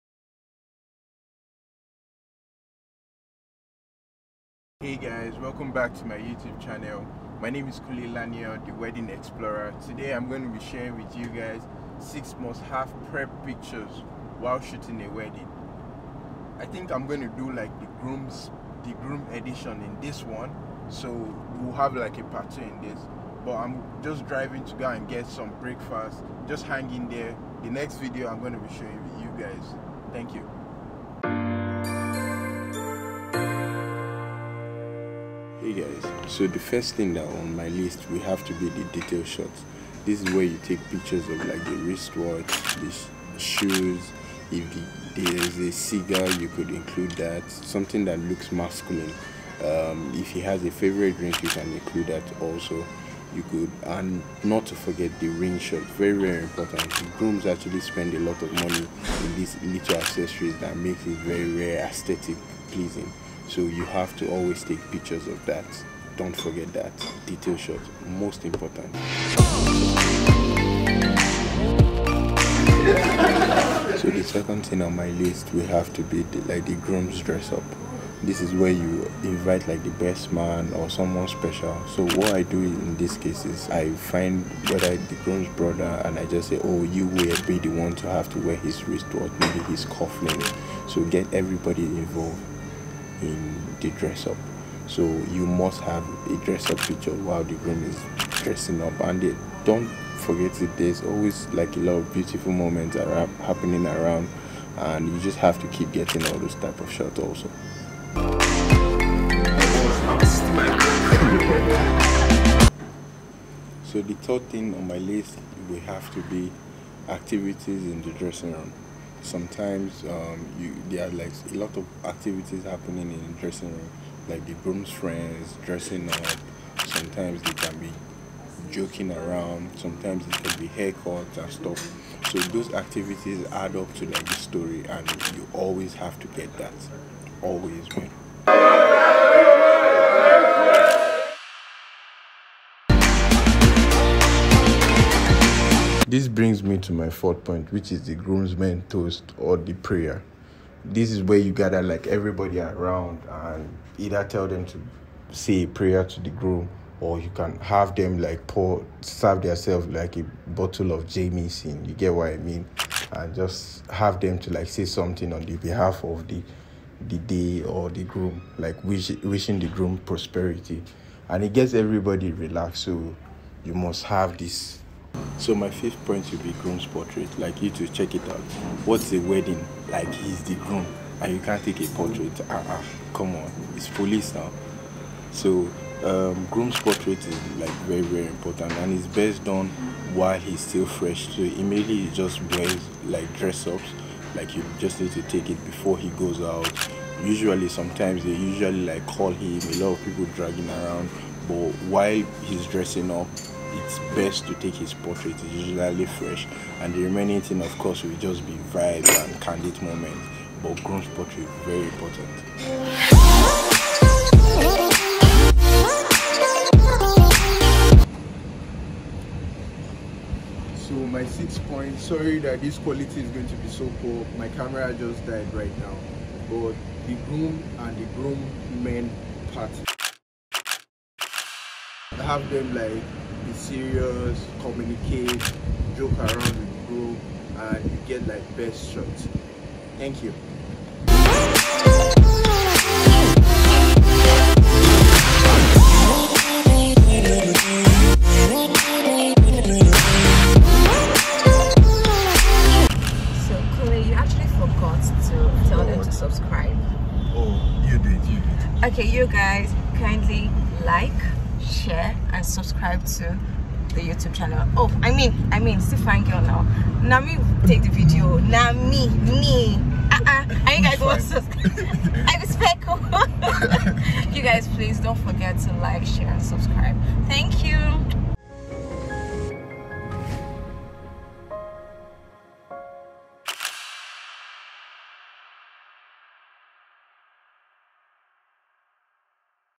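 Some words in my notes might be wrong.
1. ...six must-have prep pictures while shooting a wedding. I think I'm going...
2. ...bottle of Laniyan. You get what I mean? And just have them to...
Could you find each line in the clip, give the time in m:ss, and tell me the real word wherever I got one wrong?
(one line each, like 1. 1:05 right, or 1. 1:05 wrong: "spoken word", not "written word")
1. 0:11 right
2. 2:40 wrong: "Jameson", not "Laniyan".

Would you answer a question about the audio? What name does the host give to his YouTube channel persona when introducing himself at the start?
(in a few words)
the Wedding Explorer.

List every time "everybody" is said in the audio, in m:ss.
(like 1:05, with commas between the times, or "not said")
1:31, 2:32, 2:51.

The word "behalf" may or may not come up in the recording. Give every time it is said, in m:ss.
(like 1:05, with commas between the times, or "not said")
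2:45.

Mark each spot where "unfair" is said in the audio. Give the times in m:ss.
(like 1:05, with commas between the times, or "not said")
not said.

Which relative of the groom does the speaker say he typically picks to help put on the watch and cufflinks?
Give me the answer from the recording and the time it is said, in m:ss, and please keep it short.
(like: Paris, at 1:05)
the groom's brother, at 1:25.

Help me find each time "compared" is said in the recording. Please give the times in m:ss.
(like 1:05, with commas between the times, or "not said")
not said.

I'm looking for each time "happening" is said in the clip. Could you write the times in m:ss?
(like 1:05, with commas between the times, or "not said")
1:43, 2:02.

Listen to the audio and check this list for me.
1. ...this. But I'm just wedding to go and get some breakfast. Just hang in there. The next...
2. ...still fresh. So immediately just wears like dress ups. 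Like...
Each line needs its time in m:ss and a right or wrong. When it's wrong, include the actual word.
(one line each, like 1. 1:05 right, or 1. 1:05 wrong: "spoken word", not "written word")
1. 0:22 wrong: "driving", not "wedding"
2. 3:10 right.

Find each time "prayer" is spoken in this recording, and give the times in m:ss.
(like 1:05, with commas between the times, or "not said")
2:29, 2:35.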